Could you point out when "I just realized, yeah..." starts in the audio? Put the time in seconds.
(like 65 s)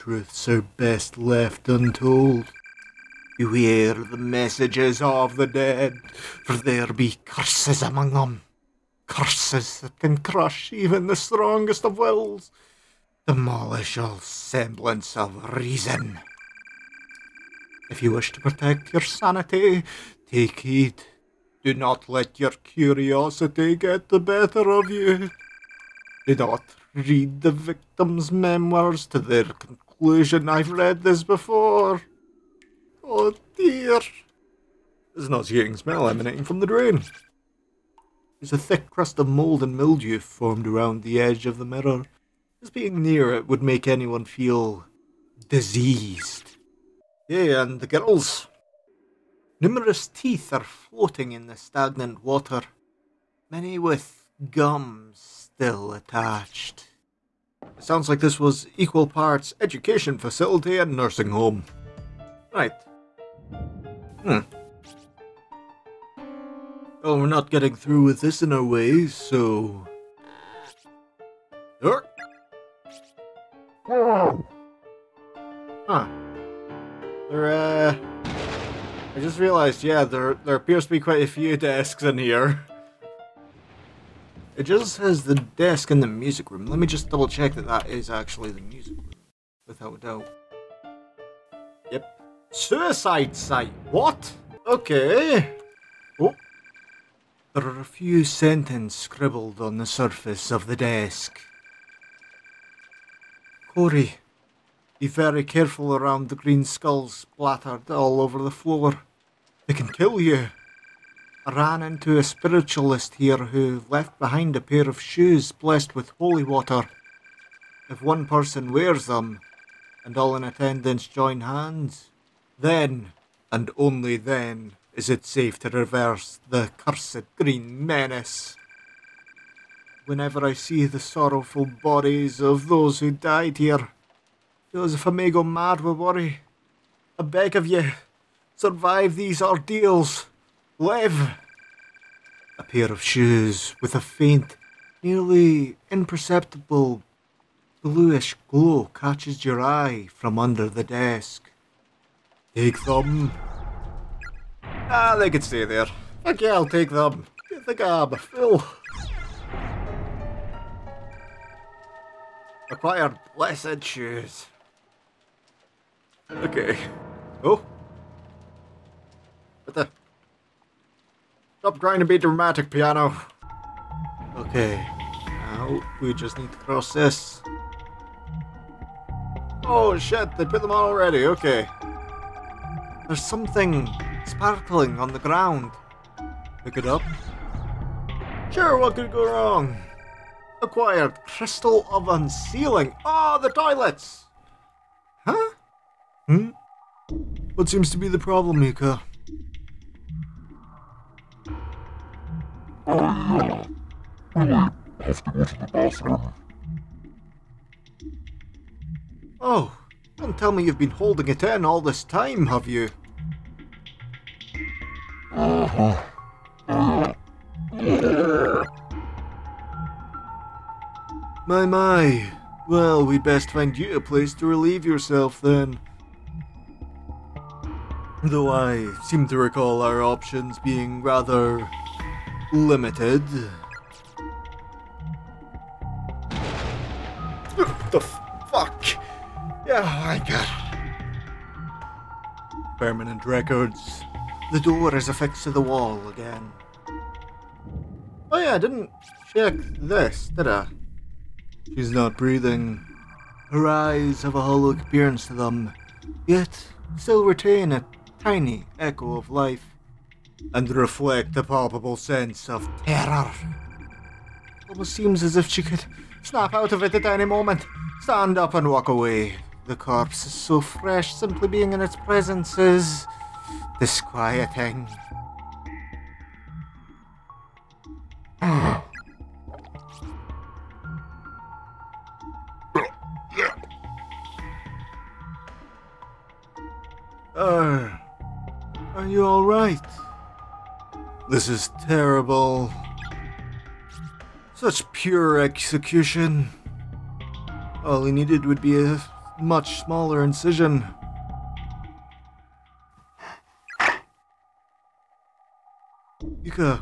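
79 s.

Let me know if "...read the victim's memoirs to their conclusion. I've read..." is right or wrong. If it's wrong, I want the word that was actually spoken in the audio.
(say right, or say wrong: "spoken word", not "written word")
right.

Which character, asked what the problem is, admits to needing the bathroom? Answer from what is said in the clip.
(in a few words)
Mika.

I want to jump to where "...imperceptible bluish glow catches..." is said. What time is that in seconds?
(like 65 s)
145 s.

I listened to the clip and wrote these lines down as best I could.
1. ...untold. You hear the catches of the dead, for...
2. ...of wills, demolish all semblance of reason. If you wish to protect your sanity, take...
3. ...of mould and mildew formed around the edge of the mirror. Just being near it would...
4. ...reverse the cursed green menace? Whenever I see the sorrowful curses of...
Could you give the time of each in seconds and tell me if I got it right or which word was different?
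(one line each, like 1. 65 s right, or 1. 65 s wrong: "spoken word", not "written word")
1. 1 s wrong: "messages", not "catches"
2. 11 s right
3. 39 s right
4. 125 s wrong: "bodies", not "curses".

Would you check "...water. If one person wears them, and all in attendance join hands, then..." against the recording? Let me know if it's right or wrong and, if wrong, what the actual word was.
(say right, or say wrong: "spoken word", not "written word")
right.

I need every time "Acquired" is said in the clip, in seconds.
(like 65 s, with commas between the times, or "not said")
162 s, 190 s.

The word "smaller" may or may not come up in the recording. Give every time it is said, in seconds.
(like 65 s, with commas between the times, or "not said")
299 s.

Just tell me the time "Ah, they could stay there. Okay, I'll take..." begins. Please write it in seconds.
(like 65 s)
154 s.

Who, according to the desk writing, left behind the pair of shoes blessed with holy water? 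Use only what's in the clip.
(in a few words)
A spiritualist.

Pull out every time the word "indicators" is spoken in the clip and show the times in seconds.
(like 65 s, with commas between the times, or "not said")
not said.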